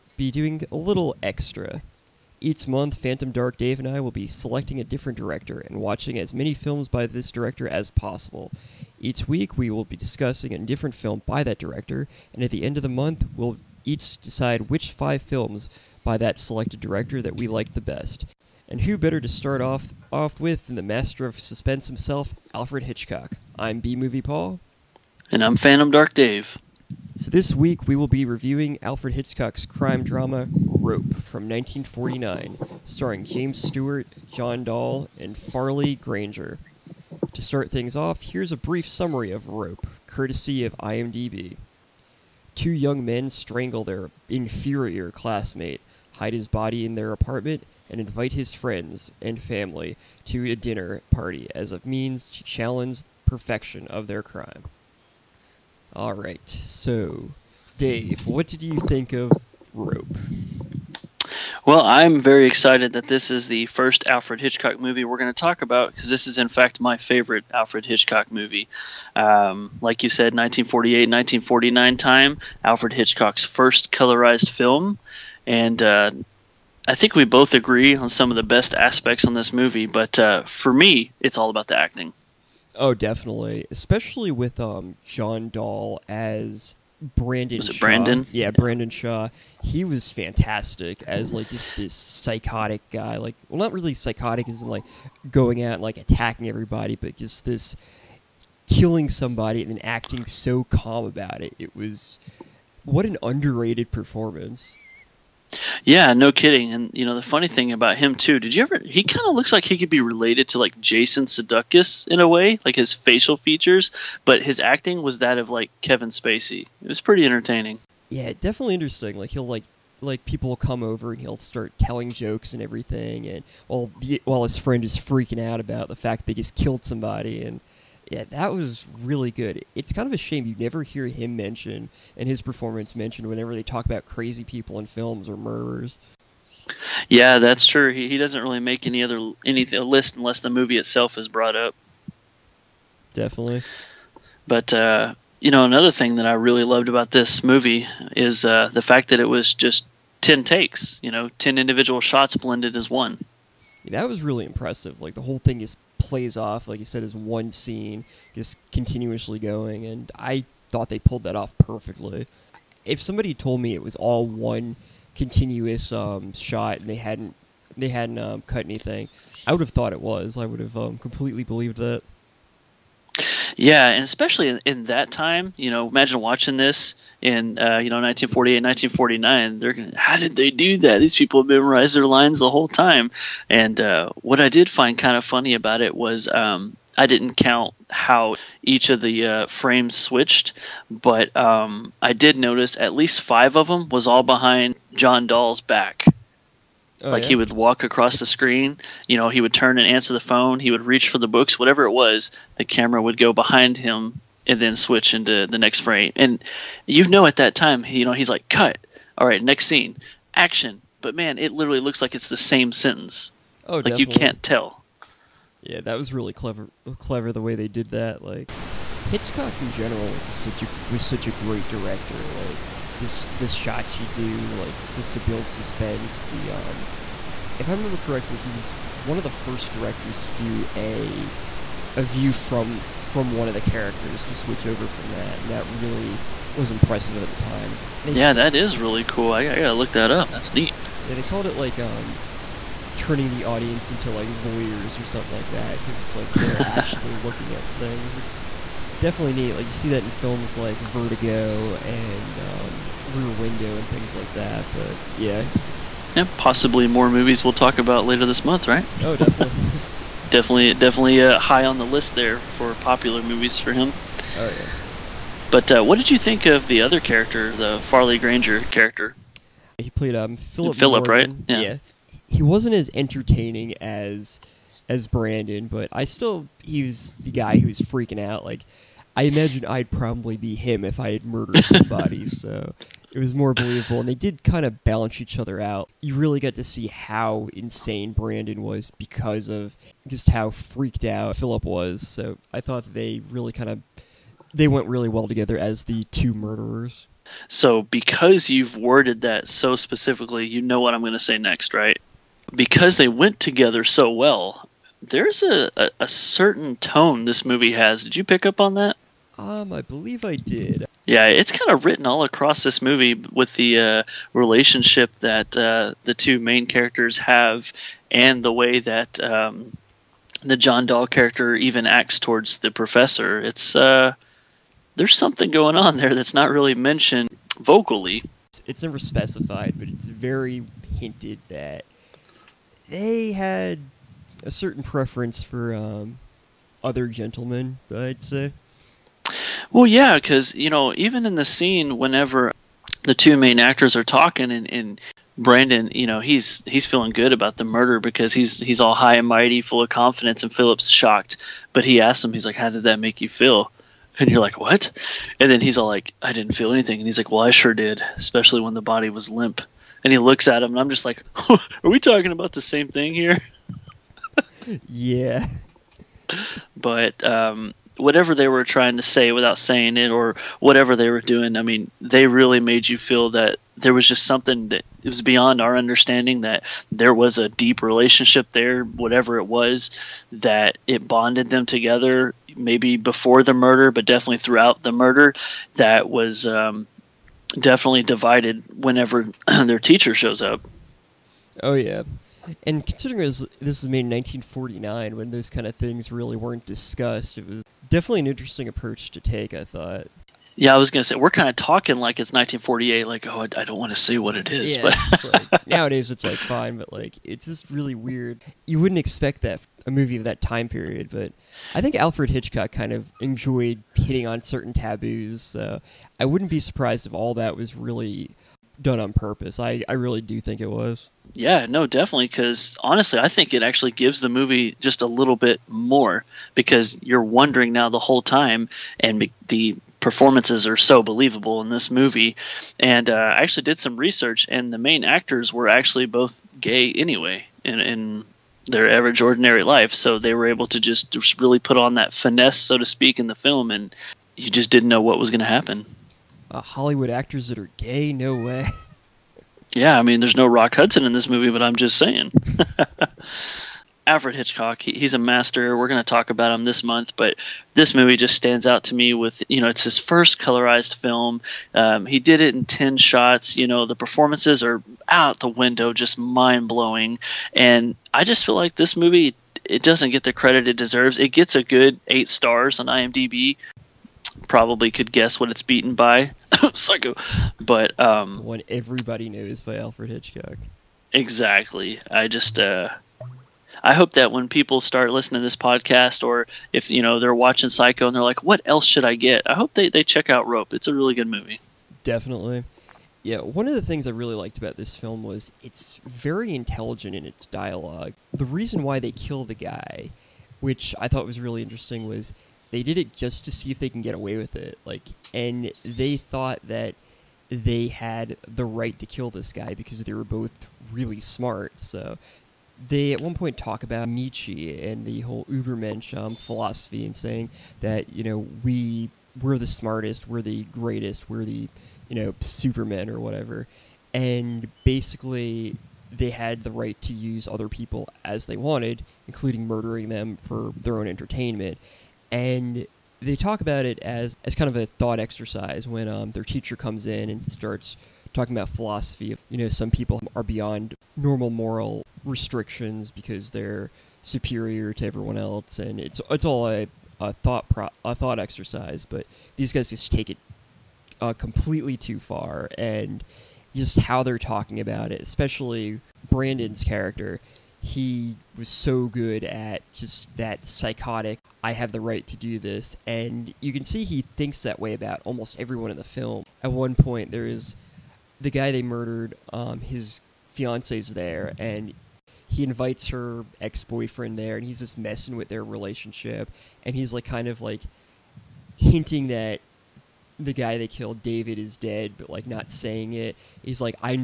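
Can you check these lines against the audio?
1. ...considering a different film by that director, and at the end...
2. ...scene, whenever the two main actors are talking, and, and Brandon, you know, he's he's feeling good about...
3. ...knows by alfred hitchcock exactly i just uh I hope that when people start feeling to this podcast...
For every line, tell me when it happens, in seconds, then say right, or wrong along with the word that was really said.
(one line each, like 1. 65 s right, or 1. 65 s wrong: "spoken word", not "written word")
1. 9 s wrong: "discussing", not "considering"
2. 341 s right
3. 479 s wrong: "listening", not "feeling".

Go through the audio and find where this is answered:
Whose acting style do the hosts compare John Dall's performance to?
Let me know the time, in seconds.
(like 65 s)
115 s.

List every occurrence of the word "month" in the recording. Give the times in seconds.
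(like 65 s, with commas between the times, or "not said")
2 s, 12 s, 258 s, 456 s.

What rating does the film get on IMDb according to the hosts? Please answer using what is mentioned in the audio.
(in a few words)
8 stars.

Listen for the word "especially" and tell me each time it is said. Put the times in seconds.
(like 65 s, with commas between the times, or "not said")
83 s, 174 s, 358 s, 555 s.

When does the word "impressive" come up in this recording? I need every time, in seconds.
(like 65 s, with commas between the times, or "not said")
154 s, 236 s.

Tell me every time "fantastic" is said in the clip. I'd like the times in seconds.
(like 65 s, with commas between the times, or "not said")
90 s.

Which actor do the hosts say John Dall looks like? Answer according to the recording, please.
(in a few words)
Jason Sudeikis.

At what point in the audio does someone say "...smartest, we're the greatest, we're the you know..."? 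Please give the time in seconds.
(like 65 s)
519 s.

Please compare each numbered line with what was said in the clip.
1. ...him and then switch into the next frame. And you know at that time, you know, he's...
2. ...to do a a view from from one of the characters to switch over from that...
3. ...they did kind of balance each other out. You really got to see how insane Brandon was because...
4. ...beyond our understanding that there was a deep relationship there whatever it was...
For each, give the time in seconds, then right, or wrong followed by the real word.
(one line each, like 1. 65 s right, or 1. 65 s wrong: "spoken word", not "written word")
1. 203 s right
2. 230 s right
3. 284 s right
4. 375 s right.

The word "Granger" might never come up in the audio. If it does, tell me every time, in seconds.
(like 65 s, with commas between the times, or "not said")
35 s, 268 s.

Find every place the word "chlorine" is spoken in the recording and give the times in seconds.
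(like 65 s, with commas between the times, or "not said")
not said.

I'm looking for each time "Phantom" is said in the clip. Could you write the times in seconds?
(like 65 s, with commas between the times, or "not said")
2 s, 25 s.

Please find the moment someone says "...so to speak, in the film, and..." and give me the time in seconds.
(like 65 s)
442 s.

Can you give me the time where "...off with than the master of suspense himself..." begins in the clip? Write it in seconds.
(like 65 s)
20 s.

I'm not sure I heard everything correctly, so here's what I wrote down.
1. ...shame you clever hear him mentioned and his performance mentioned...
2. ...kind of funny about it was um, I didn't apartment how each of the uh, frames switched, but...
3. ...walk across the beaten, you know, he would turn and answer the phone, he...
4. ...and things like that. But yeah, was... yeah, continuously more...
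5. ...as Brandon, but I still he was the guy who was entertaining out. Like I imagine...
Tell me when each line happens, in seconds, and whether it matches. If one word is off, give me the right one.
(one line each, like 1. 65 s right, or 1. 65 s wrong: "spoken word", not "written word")
1. 130 s wrong: "never", not "clever"
2. 184 s wrong: "count", not "apartment"
3. 197 s wrong: "screen", not "beaten"
4. 253 s wrong: "possibly", not "continuously"
5. 274 s wrong: "freaking", not "entertaining".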